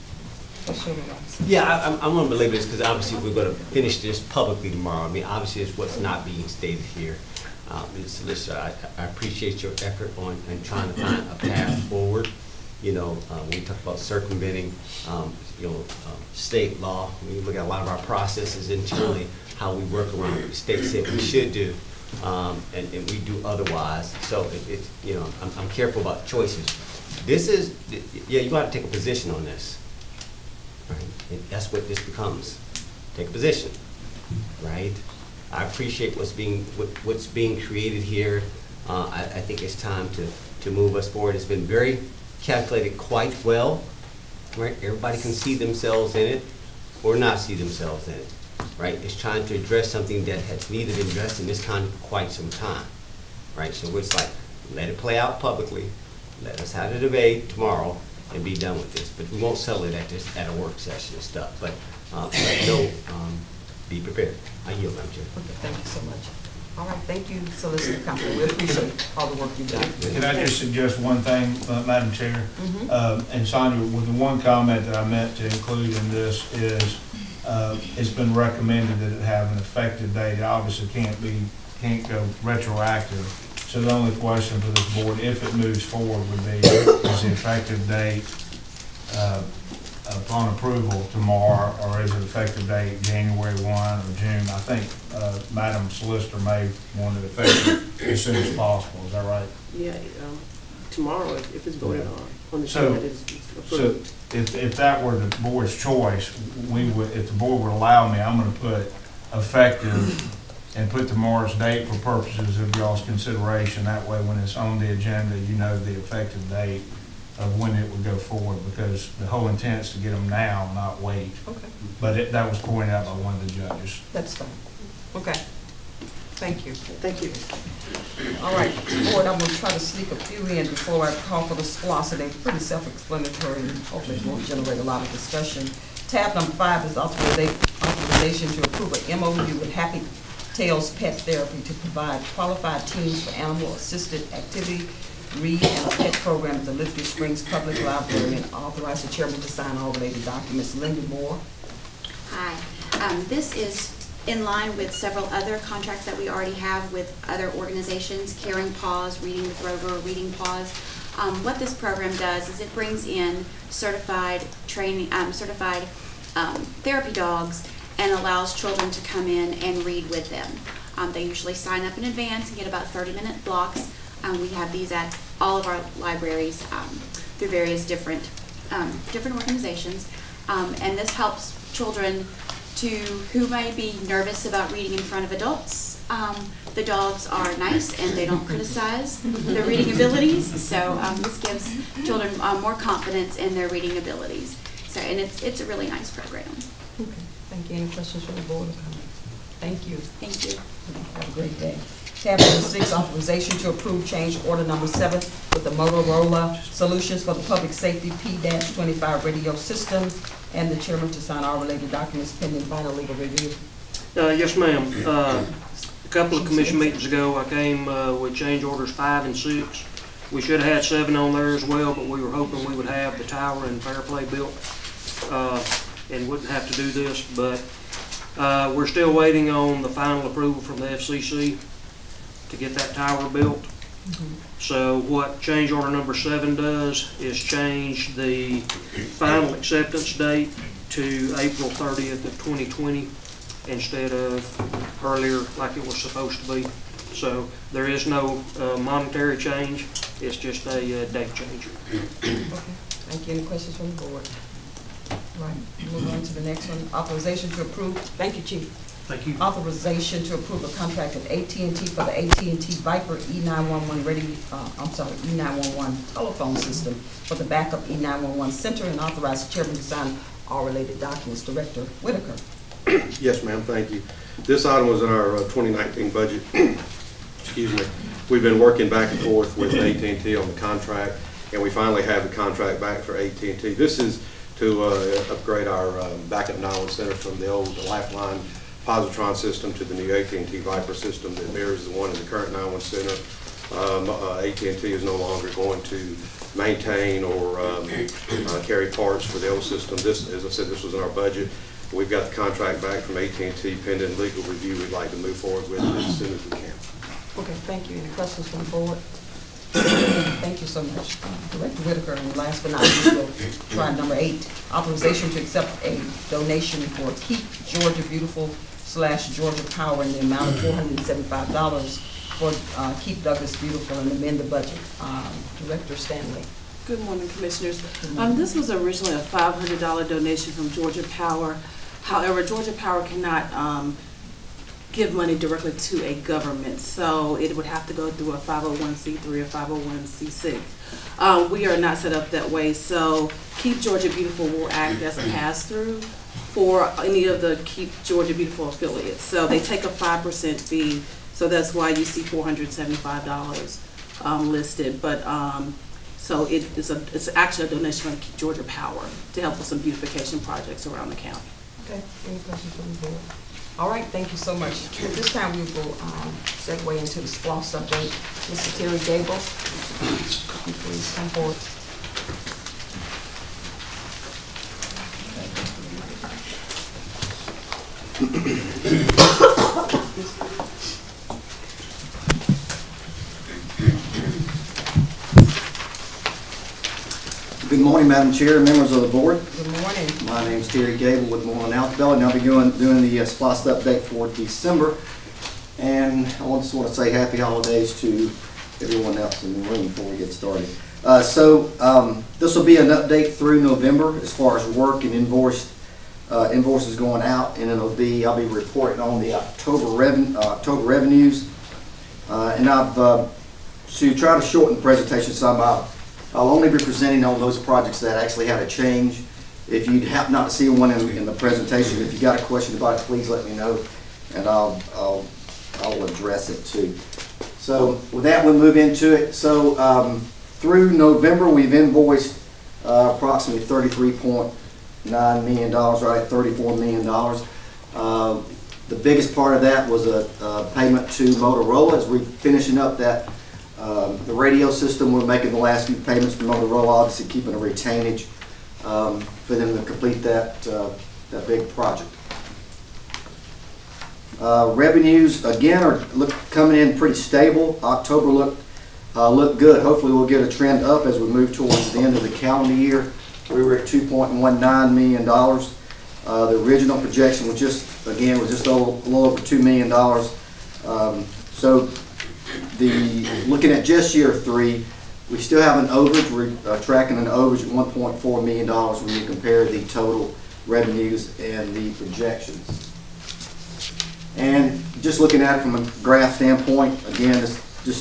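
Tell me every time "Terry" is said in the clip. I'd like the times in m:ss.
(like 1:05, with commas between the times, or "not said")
6:08, 6:30.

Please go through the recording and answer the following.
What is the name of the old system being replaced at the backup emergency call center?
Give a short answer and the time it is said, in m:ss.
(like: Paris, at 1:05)
Lifeline positron, at 4:47.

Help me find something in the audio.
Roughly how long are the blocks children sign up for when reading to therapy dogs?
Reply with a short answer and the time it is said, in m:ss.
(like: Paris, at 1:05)
30 minutes, at 2:52.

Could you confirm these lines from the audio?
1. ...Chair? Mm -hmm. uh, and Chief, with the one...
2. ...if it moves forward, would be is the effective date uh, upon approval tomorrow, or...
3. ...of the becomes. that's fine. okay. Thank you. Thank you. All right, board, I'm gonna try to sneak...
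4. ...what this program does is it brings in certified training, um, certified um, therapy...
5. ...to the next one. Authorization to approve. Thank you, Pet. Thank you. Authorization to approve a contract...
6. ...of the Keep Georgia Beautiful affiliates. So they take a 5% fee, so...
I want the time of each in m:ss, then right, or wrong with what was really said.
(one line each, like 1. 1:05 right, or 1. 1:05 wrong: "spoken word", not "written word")
1. 1:12 wrong: "Sonia", not "Chief"
2. 1:25 right
3. 2:03 wrong: "judges", not "becomes"
4. 2:41 right
5. 4:16 wrong: "Chief", not "Pet"
6. 5:47 right.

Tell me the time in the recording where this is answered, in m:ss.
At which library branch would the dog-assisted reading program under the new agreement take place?
2:26.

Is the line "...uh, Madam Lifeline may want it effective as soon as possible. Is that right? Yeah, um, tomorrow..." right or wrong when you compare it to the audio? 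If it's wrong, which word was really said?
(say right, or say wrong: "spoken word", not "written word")
wrong: "Solicitor", not "Lifeline".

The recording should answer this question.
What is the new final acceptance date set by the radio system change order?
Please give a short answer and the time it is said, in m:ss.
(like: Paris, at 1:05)
April 30th of 2020, at 4:01.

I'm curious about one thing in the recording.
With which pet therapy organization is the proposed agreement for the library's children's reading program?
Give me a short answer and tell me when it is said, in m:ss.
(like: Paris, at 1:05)
Happy Tails Pet Therapy, at 2:19.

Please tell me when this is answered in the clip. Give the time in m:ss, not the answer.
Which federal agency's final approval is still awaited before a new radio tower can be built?
3:50.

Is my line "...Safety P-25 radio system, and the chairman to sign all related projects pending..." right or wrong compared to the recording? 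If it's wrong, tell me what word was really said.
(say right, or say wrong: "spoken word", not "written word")
wrong: "documents", not "projects".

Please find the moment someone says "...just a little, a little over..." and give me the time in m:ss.
7:48.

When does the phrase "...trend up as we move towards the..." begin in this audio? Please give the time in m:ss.
7:40.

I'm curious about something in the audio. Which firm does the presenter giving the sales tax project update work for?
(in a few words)
Moreland Altobelli.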